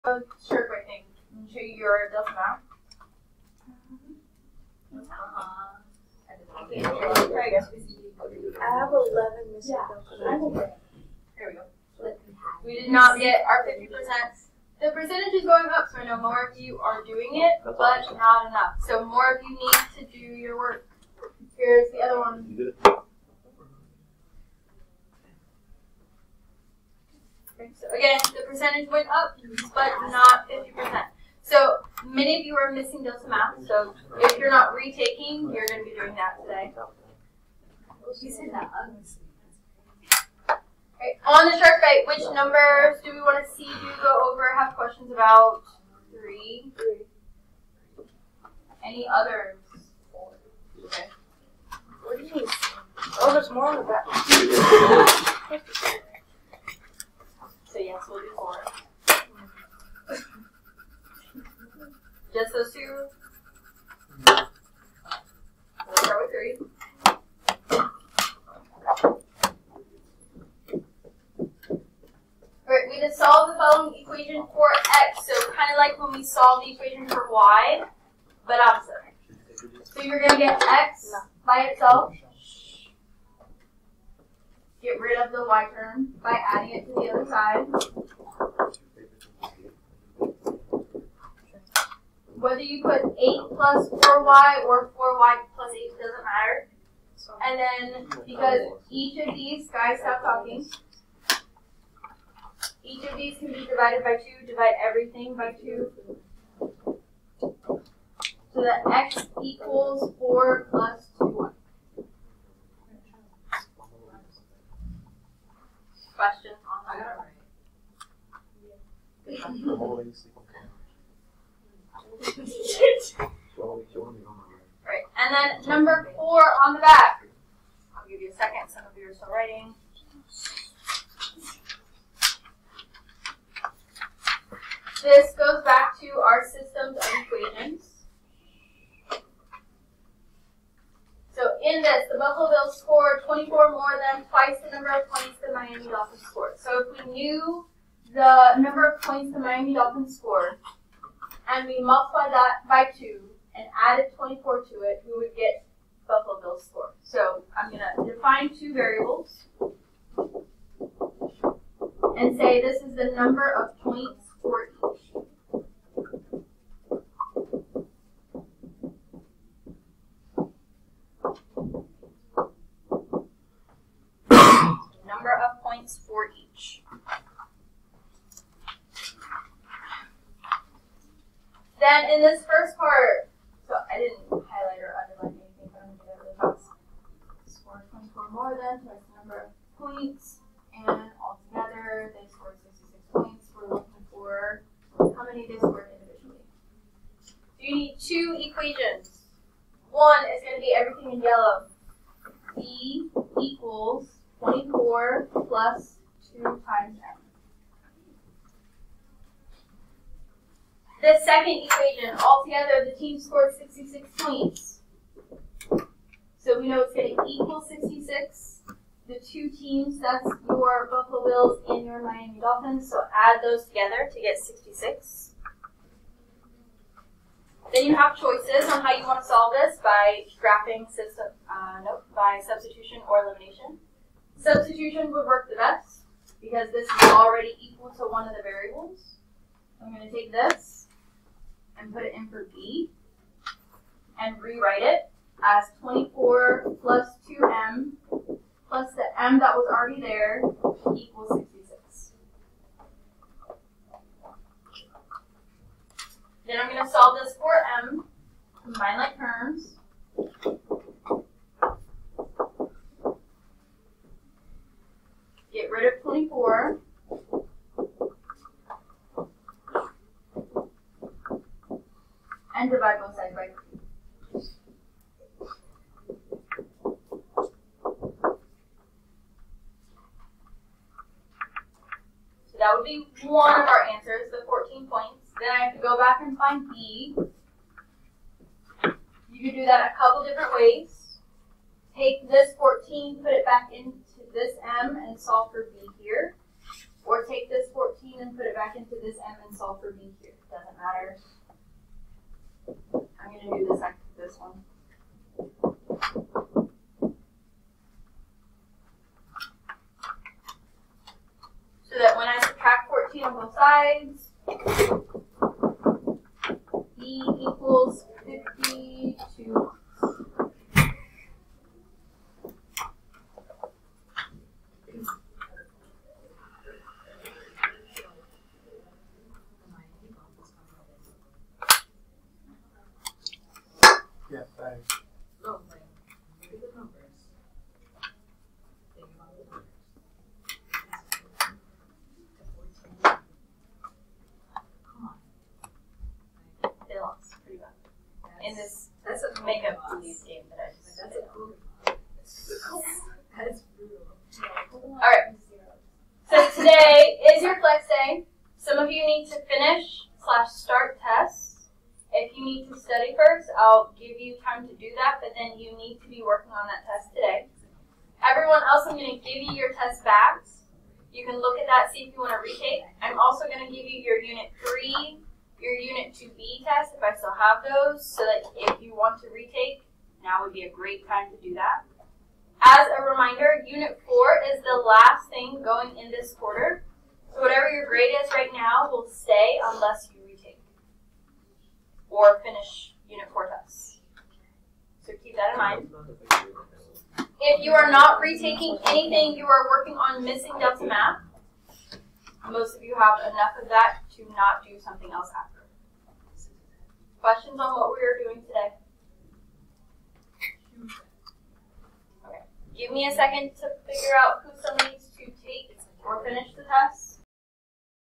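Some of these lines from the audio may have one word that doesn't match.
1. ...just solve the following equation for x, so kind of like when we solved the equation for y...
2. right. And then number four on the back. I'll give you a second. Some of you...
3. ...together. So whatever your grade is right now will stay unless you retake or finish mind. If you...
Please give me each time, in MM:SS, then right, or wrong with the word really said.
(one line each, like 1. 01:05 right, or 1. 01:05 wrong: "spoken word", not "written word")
1. 01:13 right
2. 02:04 right
3. 06:26 wrong: "quarter", not "together".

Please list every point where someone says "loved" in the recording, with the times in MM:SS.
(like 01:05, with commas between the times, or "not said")
not said.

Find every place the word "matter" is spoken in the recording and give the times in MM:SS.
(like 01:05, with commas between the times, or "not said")
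01:36, 05:00.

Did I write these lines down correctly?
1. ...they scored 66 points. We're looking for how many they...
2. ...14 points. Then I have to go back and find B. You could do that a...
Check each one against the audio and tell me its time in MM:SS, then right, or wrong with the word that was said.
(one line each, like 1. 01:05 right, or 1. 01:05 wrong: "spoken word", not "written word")
1. 03:12 right
2. 04:44 right.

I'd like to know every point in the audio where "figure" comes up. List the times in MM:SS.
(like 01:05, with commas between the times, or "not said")
06:53.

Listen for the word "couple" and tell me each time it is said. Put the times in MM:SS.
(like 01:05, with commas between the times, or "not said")
04:49.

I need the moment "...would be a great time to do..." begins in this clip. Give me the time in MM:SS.
06:20.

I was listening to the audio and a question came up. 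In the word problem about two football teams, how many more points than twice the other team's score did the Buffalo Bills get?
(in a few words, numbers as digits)
24.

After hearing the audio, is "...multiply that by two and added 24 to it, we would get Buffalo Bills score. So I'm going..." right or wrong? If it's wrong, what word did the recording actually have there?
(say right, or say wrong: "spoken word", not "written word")
right.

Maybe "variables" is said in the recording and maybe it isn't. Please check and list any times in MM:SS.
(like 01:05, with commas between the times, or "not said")
02:38, 03:58.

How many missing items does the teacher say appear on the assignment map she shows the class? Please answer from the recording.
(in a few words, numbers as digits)
11.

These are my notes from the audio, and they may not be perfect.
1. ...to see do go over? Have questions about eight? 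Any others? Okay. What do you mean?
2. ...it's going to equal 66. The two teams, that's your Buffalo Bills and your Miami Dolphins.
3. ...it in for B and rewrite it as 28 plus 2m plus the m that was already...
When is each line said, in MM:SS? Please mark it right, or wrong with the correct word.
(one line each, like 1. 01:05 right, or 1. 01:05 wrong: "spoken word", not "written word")
1. 00:43 wrong: "three", not "eight"
2. 03:36 right
3. 04:02 wrong: "24", not "28".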